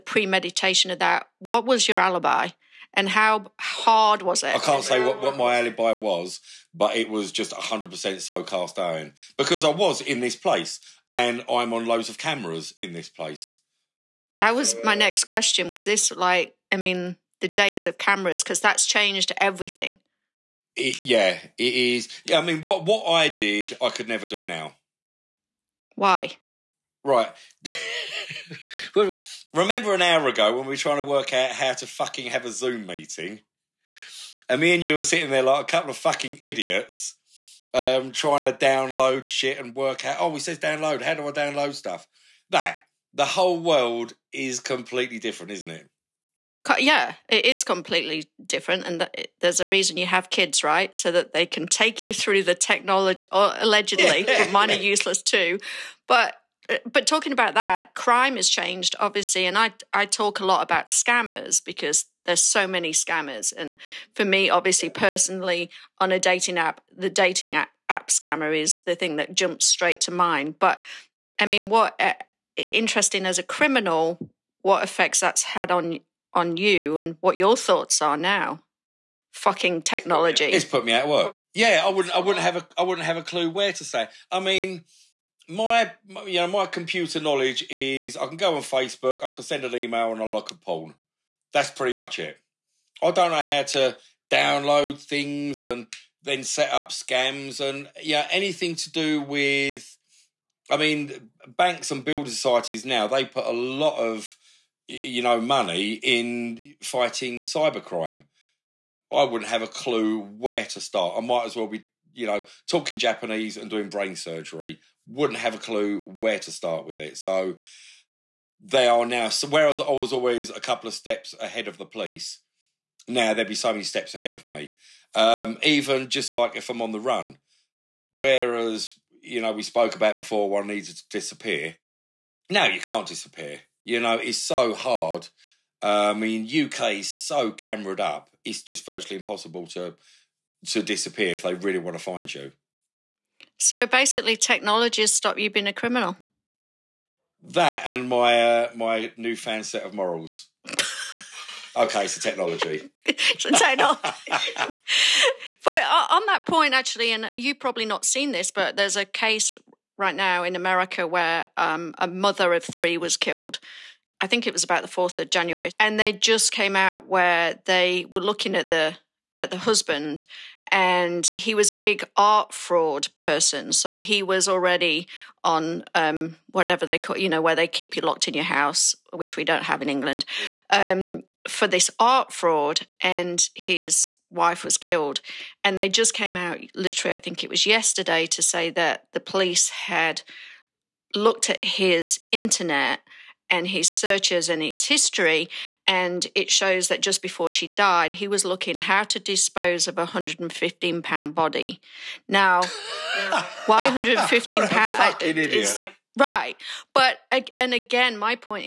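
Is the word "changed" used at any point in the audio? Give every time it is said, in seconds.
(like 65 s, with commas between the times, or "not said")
18 s, 58 s.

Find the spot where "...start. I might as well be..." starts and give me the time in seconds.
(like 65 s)
110 s.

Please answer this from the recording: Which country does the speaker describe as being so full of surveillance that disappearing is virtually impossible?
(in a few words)
UK.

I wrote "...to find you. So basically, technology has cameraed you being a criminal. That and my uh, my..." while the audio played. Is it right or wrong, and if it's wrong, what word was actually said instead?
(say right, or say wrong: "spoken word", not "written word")
wrong: "stopped", not "cameraed".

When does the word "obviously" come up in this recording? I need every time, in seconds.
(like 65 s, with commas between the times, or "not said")
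58 s, 64 s.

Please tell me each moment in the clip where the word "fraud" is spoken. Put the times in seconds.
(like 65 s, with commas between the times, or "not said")
172 s, 182 s.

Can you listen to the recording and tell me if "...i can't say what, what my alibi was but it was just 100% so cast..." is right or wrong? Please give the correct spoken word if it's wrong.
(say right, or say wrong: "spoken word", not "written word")
right.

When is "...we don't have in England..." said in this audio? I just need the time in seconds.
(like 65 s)
179 s.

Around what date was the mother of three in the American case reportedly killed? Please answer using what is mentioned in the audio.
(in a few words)
4th of January.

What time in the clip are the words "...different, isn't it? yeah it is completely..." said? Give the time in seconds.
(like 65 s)
45 s.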